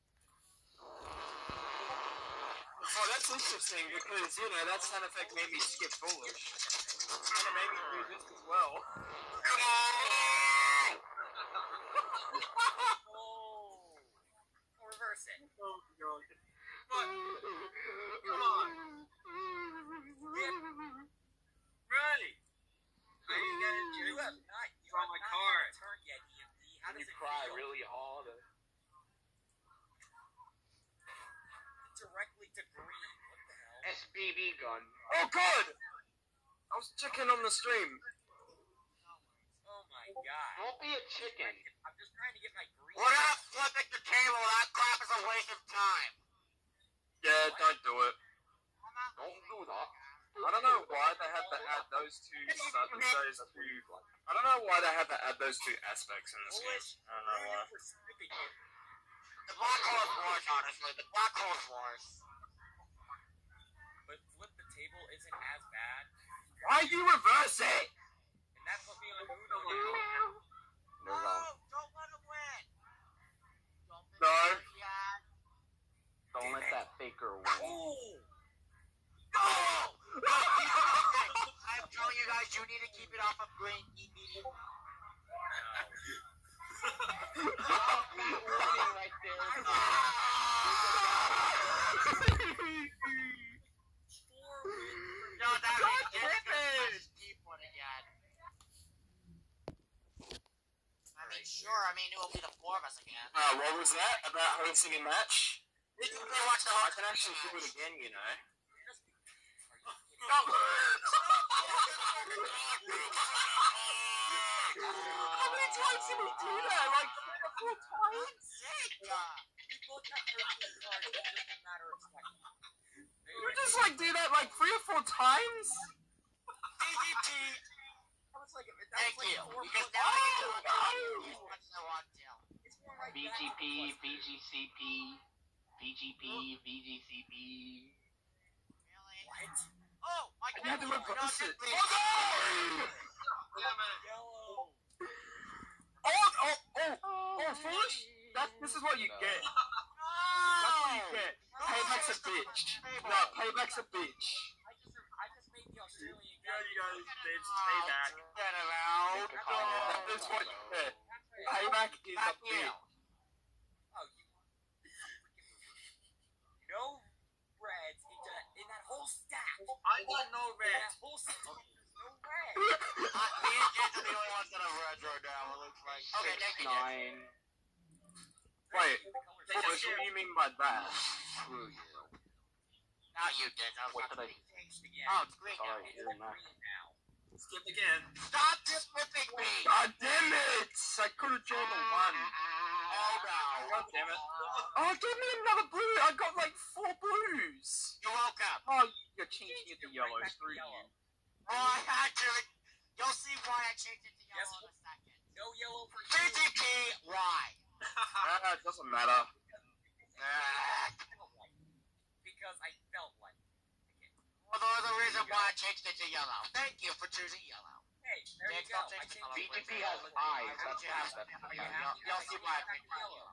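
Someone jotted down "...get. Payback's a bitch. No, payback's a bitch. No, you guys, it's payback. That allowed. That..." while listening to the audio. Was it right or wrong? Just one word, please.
right.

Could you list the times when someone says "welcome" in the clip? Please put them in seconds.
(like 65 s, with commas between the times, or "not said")
198 s.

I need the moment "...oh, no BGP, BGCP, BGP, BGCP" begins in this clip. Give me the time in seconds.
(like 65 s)
131 s.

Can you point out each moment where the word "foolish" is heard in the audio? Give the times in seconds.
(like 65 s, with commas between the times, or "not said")
5 s, 147 s.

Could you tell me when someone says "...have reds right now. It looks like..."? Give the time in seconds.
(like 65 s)
174 s.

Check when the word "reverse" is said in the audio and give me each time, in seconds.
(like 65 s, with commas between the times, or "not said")
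14 s, 67 s, 140 s.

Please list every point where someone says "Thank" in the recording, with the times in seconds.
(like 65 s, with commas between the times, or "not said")
128 s, 216 s.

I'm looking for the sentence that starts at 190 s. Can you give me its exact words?
I could have chosen uh, one.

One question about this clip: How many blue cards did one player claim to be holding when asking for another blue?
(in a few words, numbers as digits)
4.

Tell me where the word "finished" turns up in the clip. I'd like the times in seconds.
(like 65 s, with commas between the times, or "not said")
not said.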